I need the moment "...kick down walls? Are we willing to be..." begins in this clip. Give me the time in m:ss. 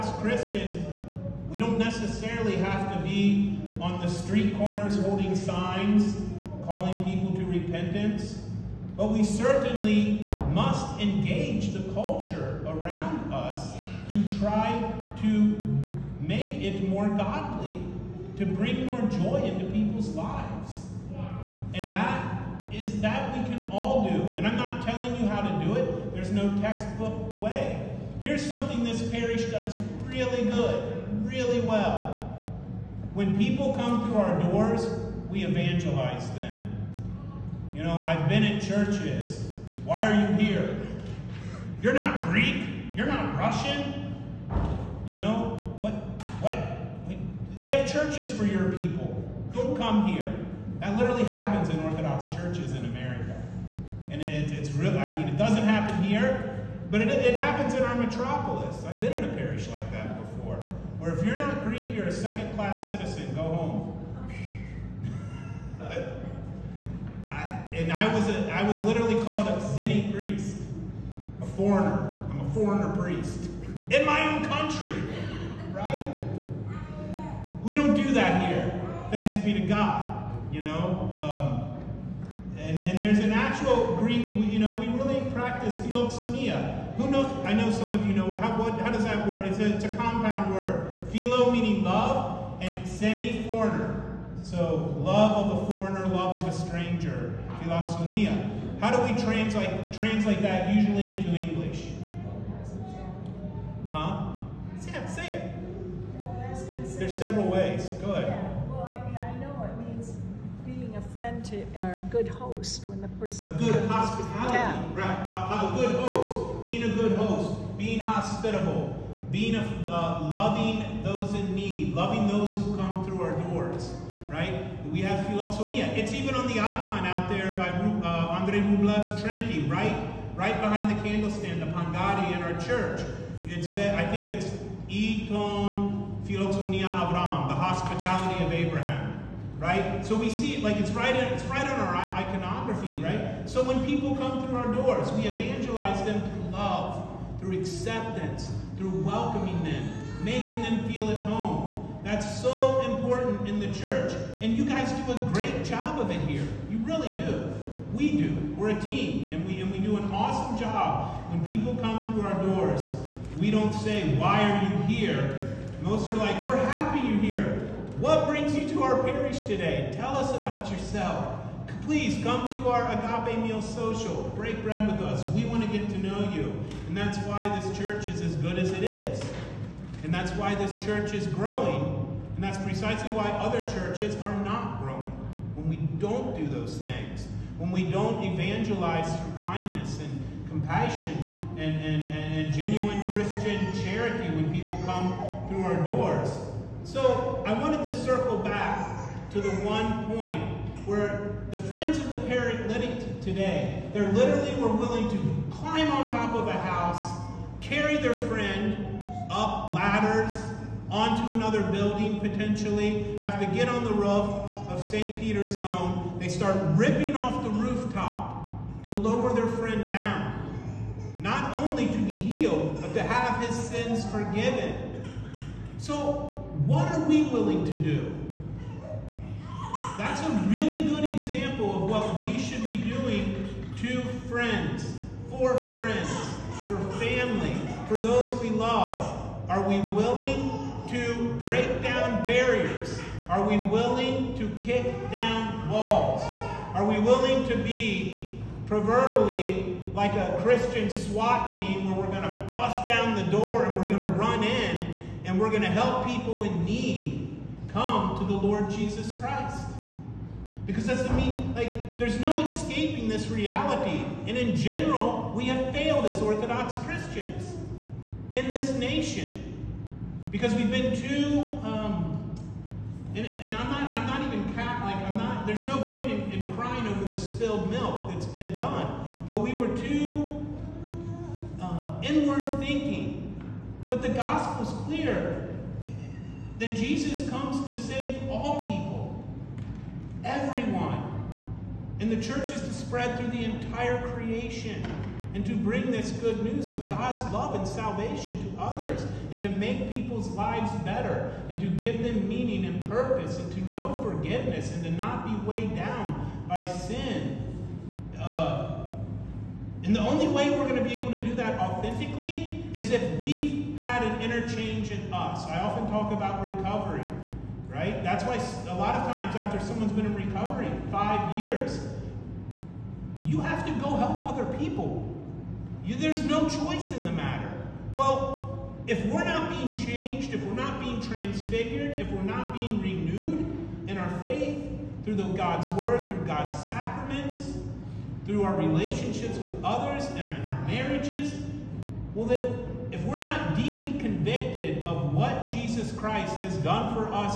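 4:04.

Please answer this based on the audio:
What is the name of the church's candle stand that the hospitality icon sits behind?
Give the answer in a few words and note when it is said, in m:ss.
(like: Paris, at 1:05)
Pangari, at 2:11.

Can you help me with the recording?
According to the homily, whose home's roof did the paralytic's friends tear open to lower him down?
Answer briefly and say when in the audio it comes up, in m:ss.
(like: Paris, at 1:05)
St. Peter, at 3:34.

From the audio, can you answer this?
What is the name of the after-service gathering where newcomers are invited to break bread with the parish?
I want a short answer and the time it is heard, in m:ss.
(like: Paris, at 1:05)
Agape Meal Social, at 2:52.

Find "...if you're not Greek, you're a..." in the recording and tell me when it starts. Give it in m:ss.
1:01.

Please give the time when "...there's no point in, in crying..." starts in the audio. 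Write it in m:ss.
4:35.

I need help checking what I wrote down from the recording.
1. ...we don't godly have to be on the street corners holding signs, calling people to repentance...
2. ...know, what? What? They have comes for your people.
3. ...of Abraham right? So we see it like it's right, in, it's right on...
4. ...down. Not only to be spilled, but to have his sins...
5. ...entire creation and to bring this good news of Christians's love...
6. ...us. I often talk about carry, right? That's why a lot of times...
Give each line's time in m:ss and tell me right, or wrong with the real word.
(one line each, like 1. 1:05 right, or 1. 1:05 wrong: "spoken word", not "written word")
1. 0:01 wrong: "necessarily", not "godly"
2. 0:45 wrong: "churches", not "comes"
3. 2:18 right
4. 3:39 wrong: "healed", not "spilled"
5. 4:53 wrong: "God", not "Christians"
6. 5:15 wrong: "recovery", not "carry".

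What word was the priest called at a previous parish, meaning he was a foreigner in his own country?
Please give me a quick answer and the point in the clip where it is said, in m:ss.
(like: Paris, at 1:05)
Zinni, at 1:09.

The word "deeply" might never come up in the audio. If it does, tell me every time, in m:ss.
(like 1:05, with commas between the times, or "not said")
5:43.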